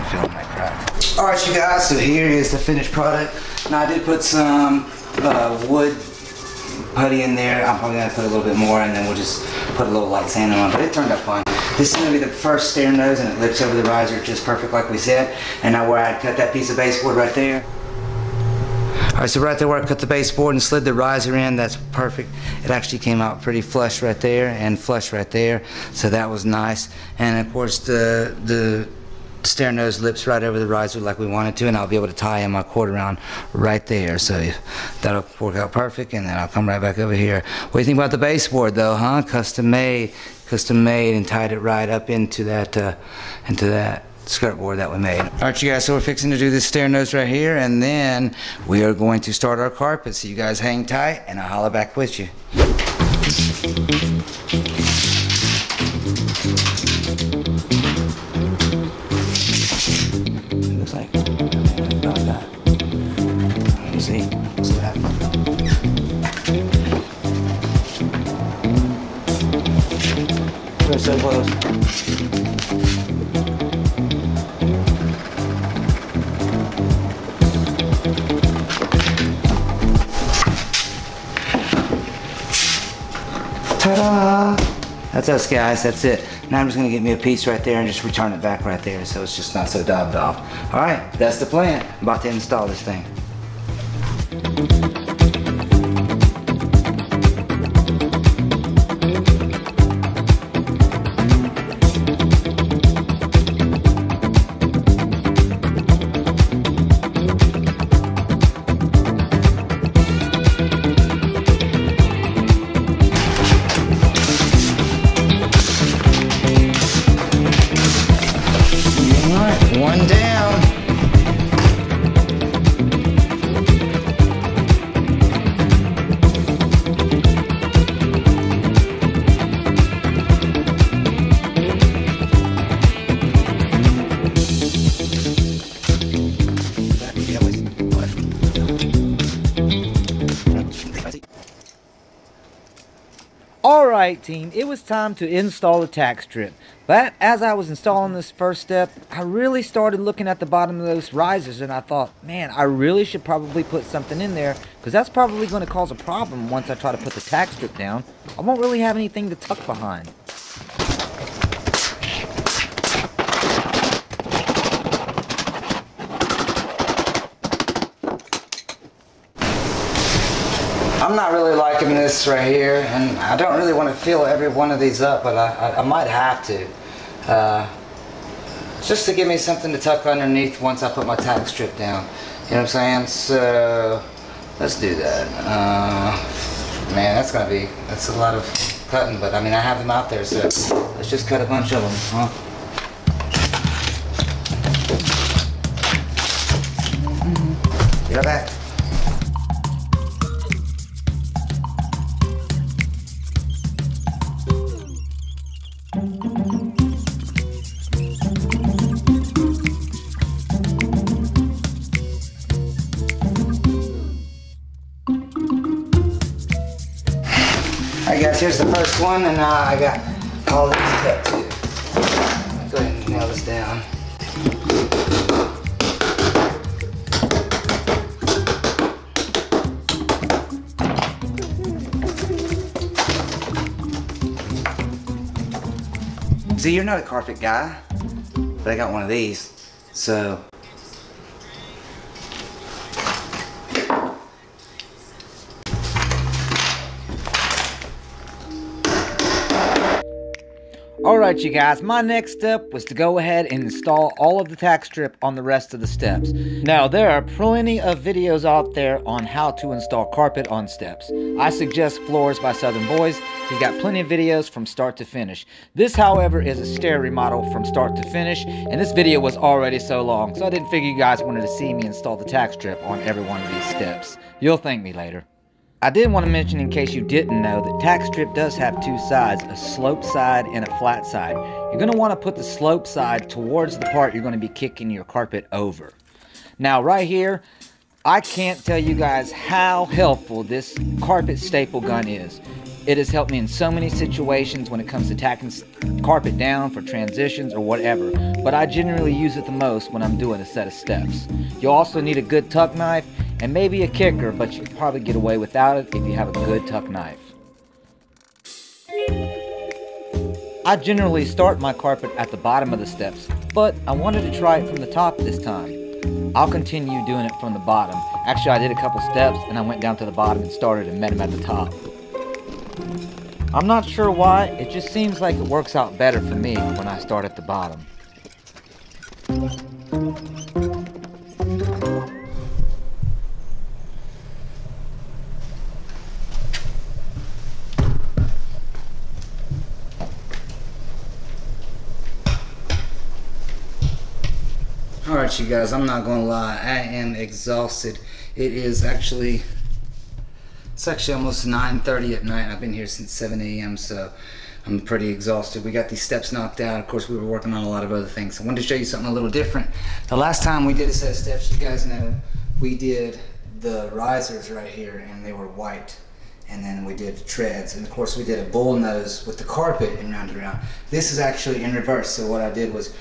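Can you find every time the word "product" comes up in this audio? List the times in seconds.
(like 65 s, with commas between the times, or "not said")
2 s.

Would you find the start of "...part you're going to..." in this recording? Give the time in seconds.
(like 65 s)
283 s.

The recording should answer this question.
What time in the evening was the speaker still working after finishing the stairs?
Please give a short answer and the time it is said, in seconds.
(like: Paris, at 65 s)
9:30, at 351 s.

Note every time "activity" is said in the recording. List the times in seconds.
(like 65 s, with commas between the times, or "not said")
not said.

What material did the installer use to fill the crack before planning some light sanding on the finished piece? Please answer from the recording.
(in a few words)
wood putty.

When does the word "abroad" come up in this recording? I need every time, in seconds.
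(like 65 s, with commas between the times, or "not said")
not said.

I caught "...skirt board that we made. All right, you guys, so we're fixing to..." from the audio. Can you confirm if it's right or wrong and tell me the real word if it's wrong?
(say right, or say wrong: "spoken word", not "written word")
right.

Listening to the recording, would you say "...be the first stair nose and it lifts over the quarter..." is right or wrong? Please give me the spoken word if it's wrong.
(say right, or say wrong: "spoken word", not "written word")
wrong: "riser", not "quarter".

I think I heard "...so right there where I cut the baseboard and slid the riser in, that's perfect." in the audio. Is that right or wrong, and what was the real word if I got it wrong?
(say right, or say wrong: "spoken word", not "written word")
right.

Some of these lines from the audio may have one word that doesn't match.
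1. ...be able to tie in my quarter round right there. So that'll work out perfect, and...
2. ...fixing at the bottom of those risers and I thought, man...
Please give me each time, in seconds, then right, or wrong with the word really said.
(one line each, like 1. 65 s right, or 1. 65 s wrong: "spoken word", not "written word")
1. 31 s right
2. 149 s wrong: "looking", not "fixing".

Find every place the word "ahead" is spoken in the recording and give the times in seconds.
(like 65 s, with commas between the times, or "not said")
222 s, 253 s.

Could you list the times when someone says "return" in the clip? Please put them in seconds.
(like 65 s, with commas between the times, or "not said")
88 s.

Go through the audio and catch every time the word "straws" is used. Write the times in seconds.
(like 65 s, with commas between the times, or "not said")
not said.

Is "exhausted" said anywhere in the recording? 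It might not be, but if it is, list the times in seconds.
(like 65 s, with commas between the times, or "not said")
347 s, 355 s.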